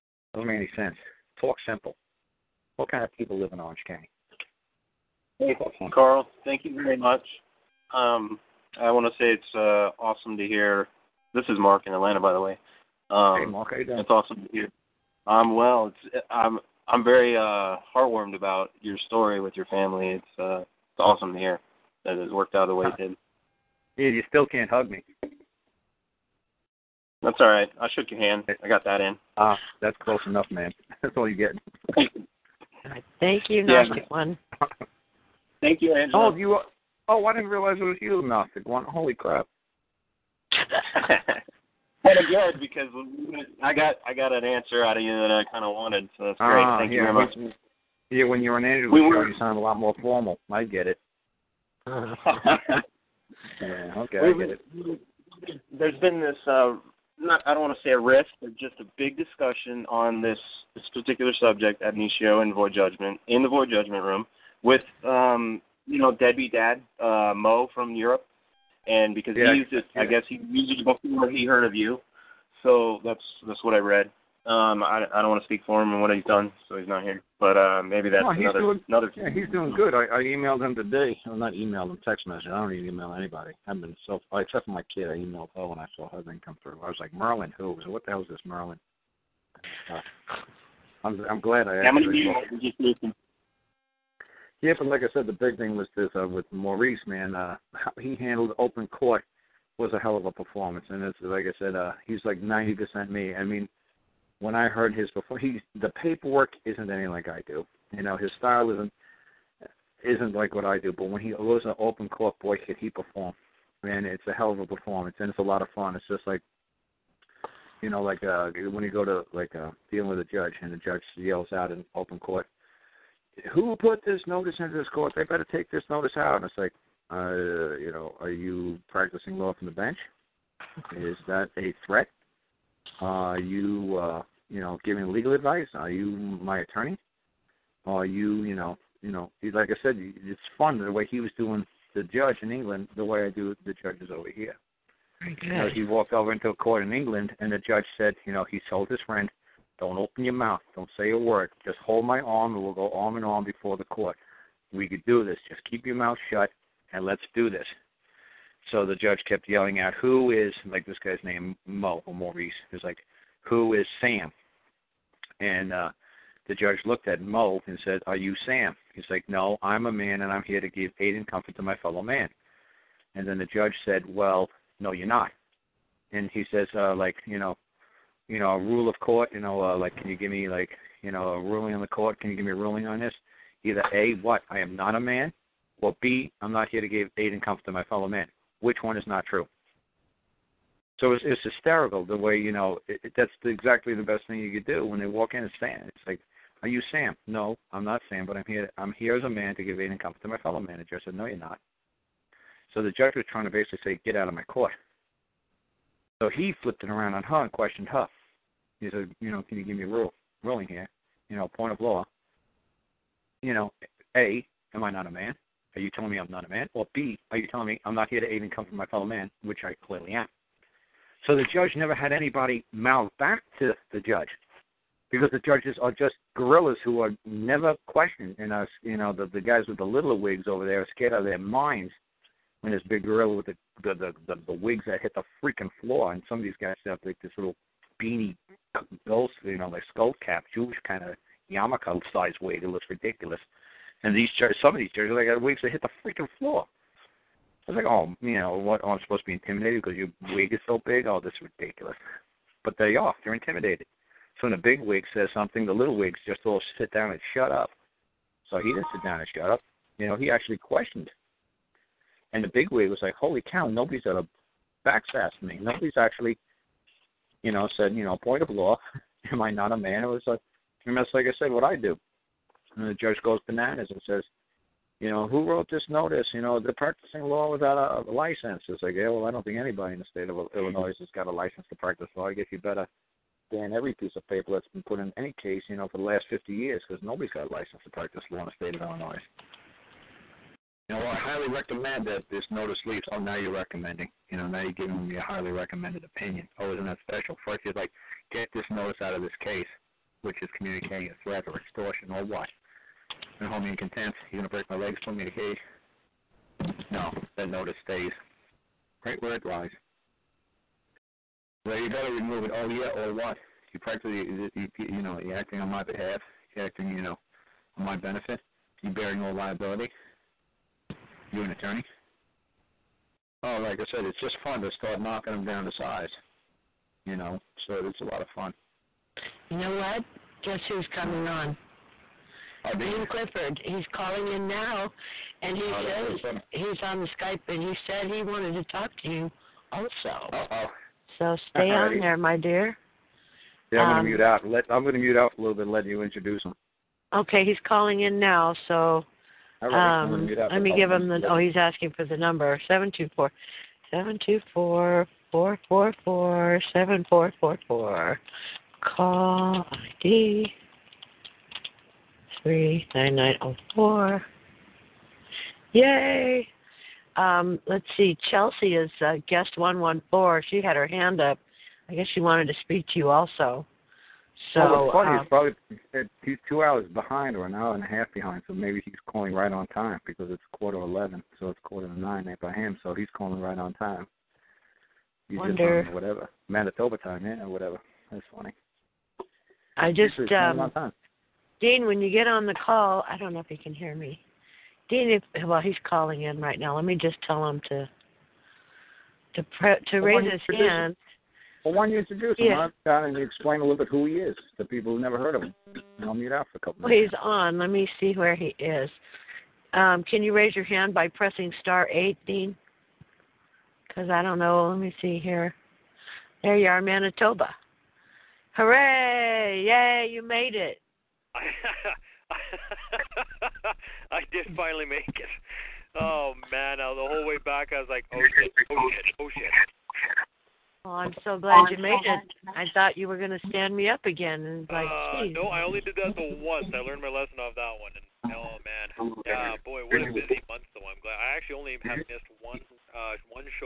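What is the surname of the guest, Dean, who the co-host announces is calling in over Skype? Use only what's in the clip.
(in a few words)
Clifford.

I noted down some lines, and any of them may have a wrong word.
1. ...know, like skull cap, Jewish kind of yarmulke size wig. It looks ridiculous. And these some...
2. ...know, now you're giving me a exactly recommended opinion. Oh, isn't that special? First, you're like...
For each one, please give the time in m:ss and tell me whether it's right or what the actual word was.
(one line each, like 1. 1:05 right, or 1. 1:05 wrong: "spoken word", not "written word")
1. 3:59 right
2. 4:54 wrong: "highly", not "exactly".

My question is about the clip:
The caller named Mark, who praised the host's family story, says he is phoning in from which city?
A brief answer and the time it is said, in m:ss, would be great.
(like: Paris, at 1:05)
Atlanta, at 0:11.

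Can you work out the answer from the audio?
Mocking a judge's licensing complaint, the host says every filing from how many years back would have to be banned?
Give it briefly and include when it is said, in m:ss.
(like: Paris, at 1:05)
50, at 4:46.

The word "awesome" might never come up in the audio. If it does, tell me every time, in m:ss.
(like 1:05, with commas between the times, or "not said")
0:10, 0:14, 0:20.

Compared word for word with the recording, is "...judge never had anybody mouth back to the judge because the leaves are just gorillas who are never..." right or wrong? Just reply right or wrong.
wrong.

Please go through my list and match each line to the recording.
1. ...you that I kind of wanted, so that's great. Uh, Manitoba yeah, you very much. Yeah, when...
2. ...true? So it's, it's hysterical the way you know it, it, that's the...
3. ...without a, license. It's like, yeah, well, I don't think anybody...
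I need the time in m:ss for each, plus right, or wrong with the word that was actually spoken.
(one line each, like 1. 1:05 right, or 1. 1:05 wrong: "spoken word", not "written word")
1. 0:45 wrong: "Thank", not "Manitoba"
2. 3:09 right
3. 4:37 right.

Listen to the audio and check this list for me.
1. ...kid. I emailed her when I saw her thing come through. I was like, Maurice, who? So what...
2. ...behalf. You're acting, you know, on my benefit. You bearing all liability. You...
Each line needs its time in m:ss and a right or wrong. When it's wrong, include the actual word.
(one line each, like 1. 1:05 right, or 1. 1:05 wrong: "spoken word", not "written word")
1. 1:24 wrong: "Merlin", not "Maurice"
2. 5:15 right.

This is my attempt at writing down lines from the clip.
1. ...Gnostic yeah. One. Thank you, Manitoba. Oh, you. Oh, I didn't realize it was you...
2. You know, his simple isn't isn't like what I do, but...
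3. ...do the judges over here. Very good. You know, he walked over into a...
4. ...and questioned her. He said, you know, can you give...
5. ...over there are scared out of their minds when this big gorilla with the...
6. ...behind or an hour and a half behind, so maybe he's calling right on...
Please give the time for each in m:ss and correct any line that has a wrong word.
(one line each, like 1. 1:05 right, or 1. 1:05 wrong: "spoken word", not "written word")
1. 0:33 wrong: "Angela", not "Manitoba"
2. 1:47 wrong: "style", not "simple"
3. 2:23 right
4. 3:27 right
5. 3:50 right
6. 6:16 right.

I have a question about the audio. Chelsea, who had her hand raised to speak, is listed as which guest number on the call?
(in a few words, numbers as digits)
114.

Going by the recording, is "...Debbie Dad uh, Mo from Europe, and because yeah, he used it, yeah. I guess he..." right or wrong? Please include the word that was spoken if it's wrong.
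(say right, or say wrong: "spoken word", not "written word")
right.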